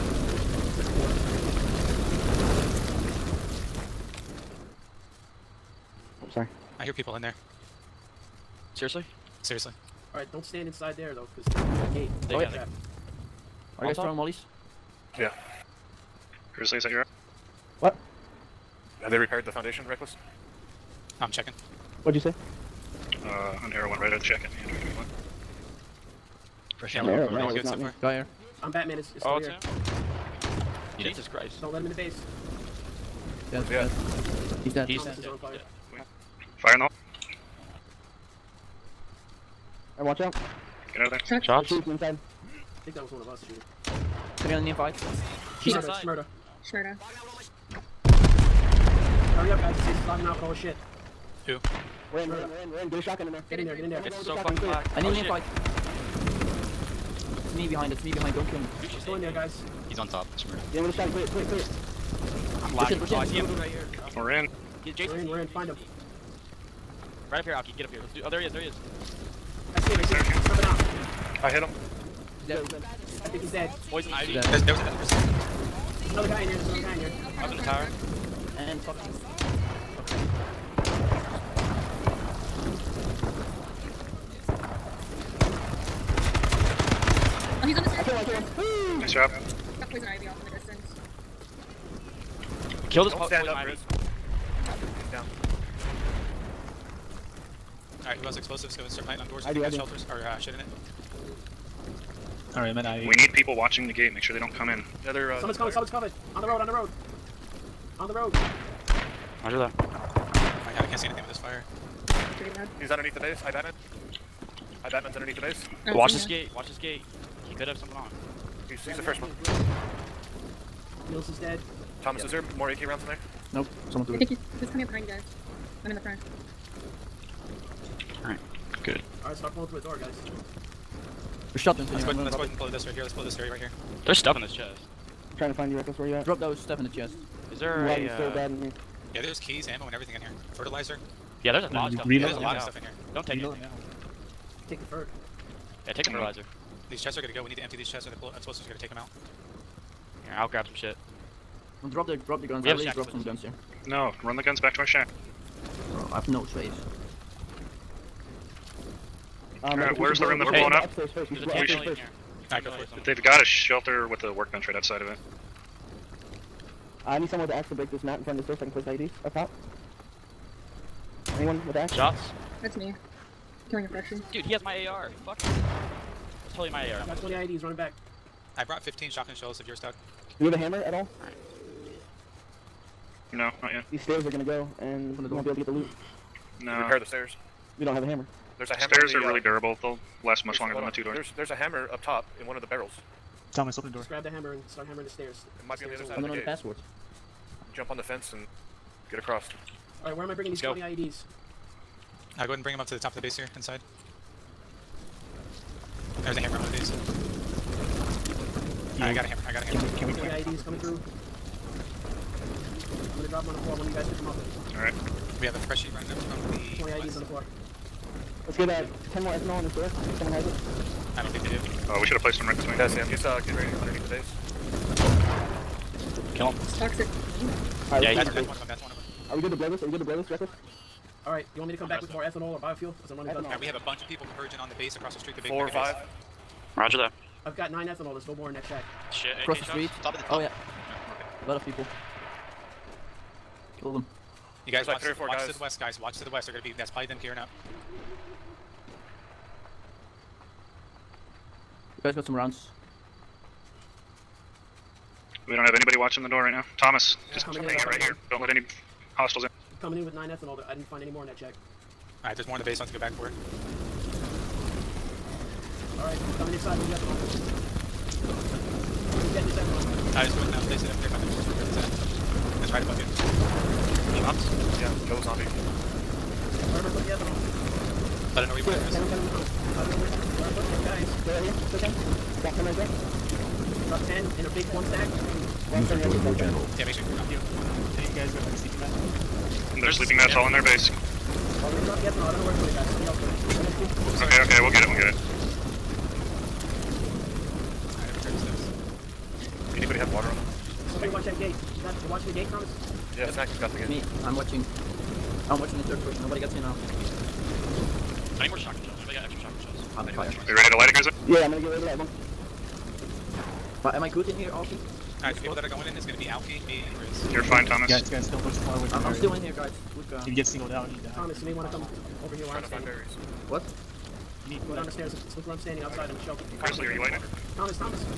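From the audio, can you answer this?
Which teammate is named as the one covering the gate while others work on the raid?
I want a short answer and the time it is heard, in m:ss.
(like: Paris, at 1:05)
Snackup, at 5:03.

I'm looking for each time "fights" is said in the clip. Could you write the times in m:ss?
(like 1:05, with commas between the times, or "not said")
0:44, 0:55.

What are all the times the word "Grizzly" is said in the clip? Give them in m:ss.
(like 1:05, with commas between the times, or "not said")
5:10, 5:26.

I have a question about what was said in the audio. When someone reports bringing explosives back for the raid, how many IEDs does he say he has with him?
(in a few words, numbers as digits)
20.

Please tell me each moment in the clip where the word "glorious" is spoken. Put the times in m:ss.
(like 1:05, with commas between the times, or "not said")
not said.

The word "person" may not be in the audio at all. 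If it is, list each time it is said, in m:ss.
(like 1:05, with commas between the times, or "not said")
1:14, 5:06.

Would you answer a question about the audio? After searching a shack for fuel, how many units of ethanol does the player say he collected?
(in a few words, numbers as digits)
9.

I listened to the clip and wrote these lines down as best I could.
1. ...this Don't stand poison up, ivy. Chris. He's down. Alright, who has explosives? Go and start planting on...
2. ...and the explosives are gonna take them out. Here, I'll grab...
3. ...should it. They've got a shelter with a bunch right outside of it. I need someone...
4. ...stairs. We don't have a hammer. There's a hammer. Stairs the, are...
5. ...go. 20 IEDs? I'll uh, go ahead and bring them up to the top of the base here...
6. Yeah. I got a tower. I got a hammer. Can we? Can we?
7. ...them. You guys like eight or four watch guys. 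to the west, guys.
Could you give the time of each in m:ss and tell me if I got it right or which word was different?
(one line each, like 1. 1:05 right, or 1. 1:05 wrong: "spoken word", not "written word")
1. 1:33 right
2. 2:28 right
3. 2:41 wrong: "workbench", not "bunch"
4. 3:07 right
5. 3:20 right
6. 3:28 wrong: "hammer", not "tower"
7. 4:03 wrong: "three", not "eight".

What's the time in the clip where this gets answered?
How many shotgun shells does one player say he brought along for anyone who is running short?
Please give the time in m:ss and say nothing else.
2:58.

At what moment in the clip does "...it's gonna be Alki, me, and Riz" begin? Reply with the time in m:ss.
5:15.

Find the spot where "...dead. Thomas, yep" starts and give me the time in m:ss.
2:01.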